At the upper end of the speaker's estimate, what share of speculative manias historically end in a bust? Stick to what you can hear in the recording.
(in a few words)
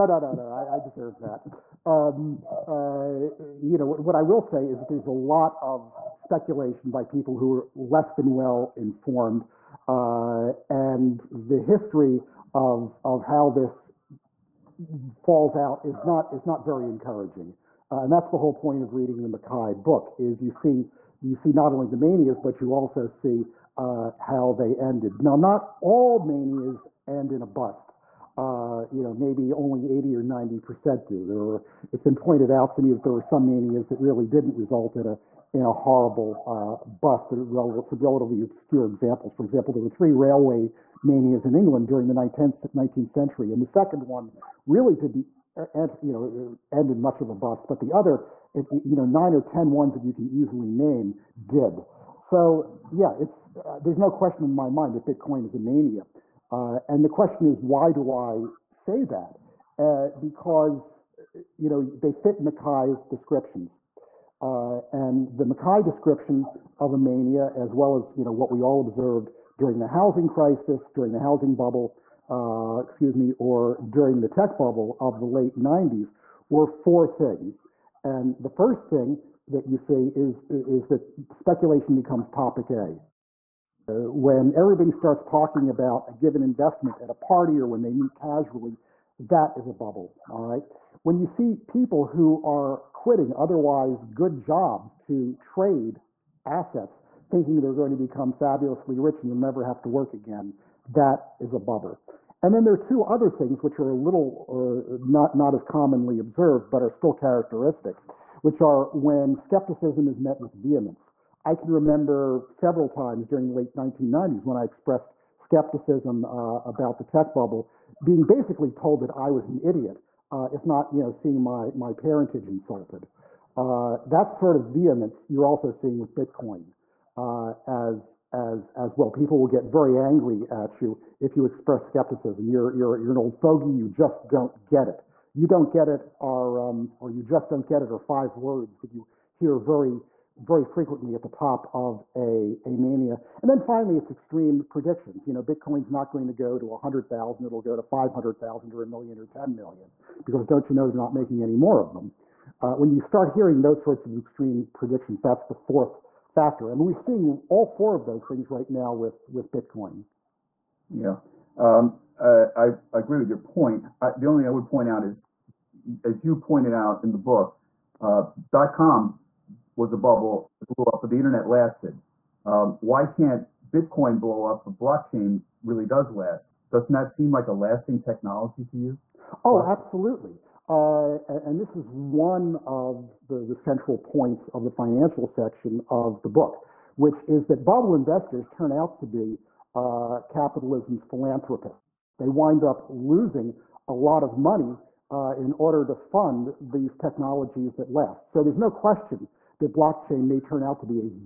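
90 percent.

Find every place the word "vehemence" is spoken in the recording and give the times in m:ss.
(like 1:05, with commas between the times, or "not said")
1:50, 2:04.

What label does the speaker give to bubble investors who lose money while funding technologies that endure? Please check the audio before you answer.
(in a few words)
capitalism's philanthropists.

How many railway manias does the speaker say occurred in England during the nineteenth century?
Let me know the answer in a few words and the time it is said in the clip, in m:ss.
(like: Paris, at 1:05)
3, at 0:39.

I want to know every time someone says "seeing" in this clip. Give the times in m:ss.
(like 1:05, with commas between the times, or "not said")
2:01, 2:05, 2:36.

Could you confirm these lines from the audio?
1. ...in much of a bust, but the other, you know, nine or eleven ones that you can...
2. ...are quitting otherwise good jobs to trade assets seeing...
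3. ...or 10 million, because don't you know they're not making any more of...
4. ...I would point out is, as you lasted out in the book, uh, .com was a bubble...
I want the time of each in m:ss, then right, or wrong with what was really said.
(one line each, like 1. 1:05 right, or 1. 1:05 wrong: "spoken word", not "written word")
1. 0:46 wrong: "ten", not "eleven"
2. 1:32 wrong: "thinking", not "seeing"
3. 2:29 right
4. 2:44 wrong: "pointed", not "lasted".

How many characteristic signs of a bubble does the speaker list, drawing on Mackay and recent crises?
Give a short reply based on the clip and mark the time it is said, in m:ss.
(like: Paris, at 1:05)
4, at 1:16.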